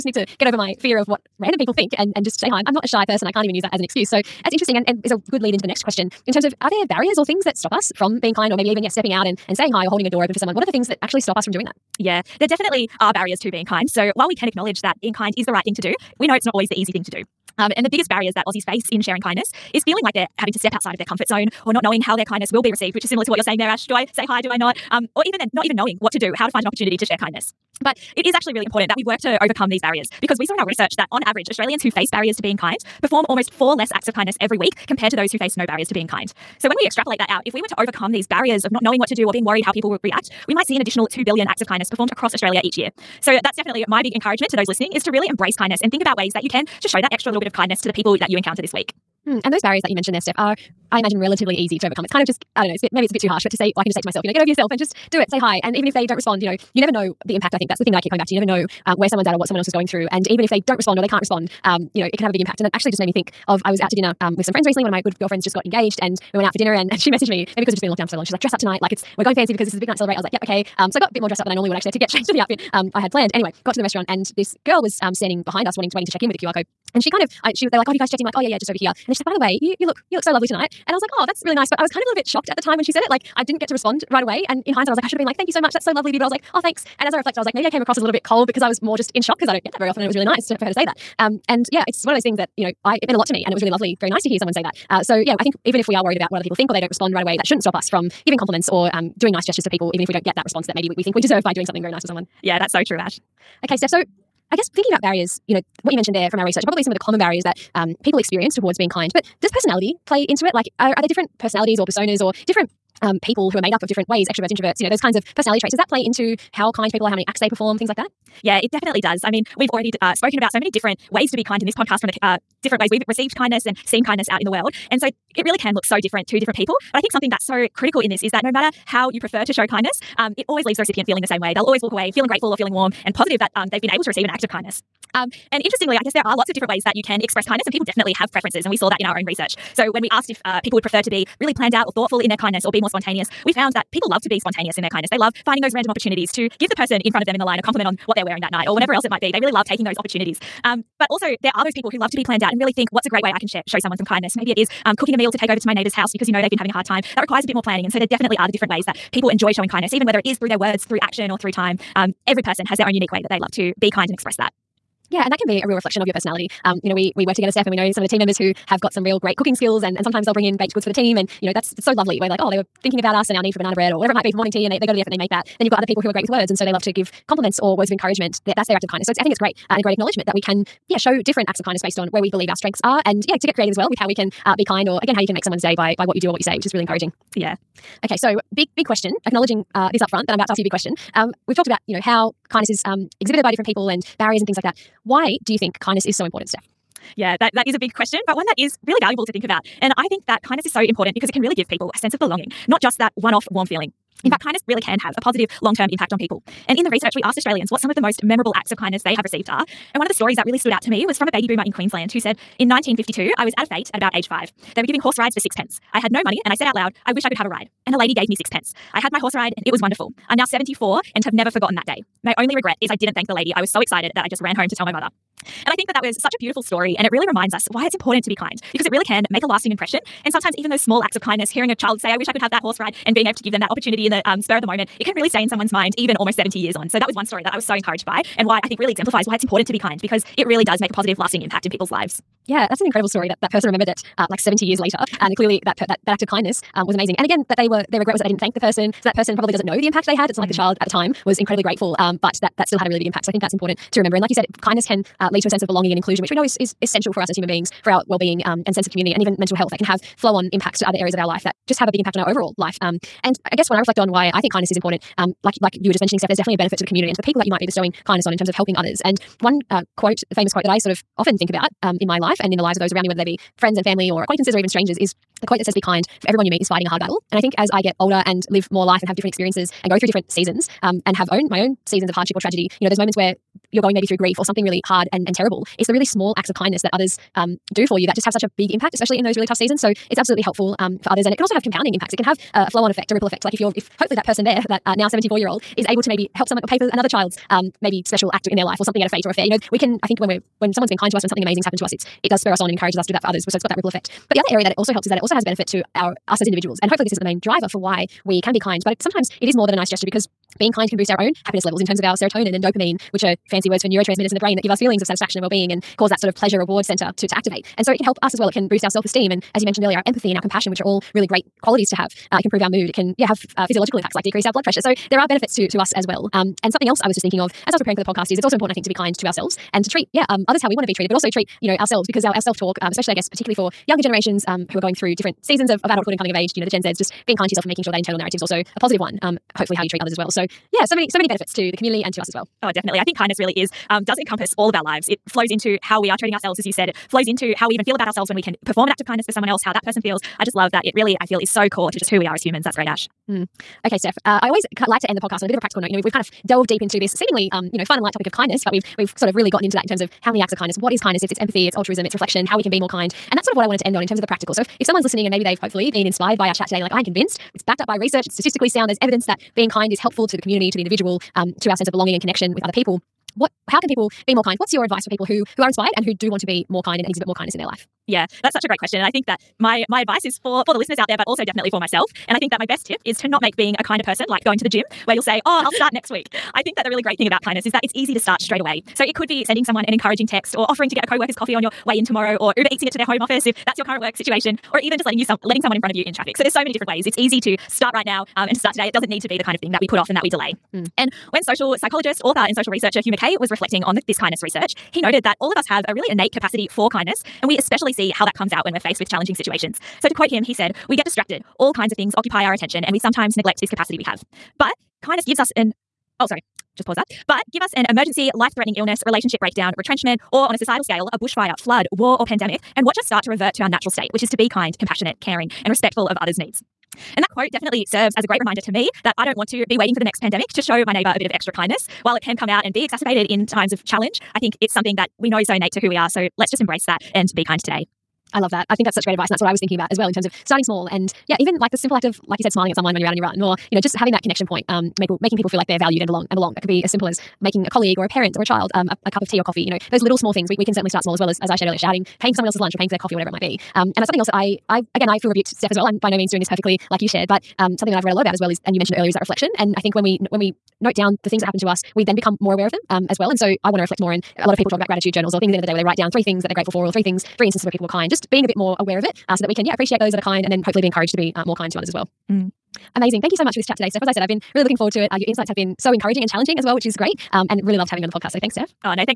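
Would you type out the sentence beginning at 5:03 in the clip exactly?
So it's got that ripple effect.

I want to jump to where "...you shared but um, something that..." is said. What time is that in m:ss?
7:37.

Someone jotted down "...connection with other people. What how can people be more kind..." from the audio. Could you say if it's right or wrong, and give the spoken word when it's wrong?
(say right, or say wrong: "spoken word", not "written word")
right.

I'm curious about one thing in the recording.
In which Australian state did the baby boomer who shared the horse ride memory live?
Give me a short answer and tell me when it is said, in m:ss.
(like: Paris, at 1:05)
Queensland, at 3:31.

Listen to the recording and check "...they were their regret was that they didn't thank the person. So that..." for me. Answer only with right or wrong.
right.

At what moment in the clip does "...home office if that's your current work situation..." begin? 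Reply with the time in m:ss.
6:33.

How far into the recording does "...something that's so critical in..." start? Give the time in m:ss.
2:07.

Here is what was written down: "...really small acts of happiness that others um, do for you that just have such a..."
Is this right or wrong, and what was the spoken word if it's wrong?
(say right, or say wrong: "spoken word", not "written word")
wrong: "kindness", not "happiness".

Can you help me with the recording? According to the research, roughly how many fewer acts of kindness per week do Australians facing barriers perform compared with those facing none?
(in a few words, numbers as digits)
4.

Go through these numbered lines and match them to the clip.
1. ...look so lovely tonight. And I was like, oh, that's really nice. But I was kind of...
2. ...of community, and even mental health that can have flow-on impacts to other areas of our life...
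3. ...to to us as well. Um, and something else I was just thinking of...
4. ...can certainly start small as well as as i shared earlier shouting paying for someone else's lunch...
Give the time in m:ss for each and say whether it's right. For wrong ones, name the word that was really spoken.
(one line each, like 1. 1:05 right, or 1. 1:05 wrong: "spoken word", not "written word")
1. 1:20 right
2. 4:18 right
3. 5:25 right
4. 7:30 right.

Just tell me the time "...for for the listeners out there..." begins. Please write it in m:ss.
6:20.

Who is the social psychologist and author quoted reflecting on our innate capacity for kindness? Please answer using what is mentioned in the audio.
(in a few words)
Hugh Mackay.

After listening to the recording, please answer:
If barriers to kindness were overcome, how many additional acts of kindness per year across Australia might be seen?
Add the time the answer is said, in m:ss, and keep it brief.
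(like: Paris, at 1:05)
2 billion, at 0:41.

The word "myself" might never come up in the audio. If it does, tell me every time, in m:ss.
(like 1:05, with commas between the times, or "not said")
0:54, 6:21.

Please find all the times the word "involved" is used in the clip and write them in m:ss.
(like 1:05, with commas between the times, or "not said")
not said.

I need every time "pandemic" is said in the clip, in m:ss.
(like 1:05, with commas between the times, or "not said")
7:02, 7:10.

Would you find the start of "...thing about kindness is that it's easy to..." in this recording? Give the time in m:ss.
6:27.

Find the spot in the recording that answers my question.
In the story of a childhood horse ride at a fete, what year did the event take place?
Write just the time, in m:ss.
3:32.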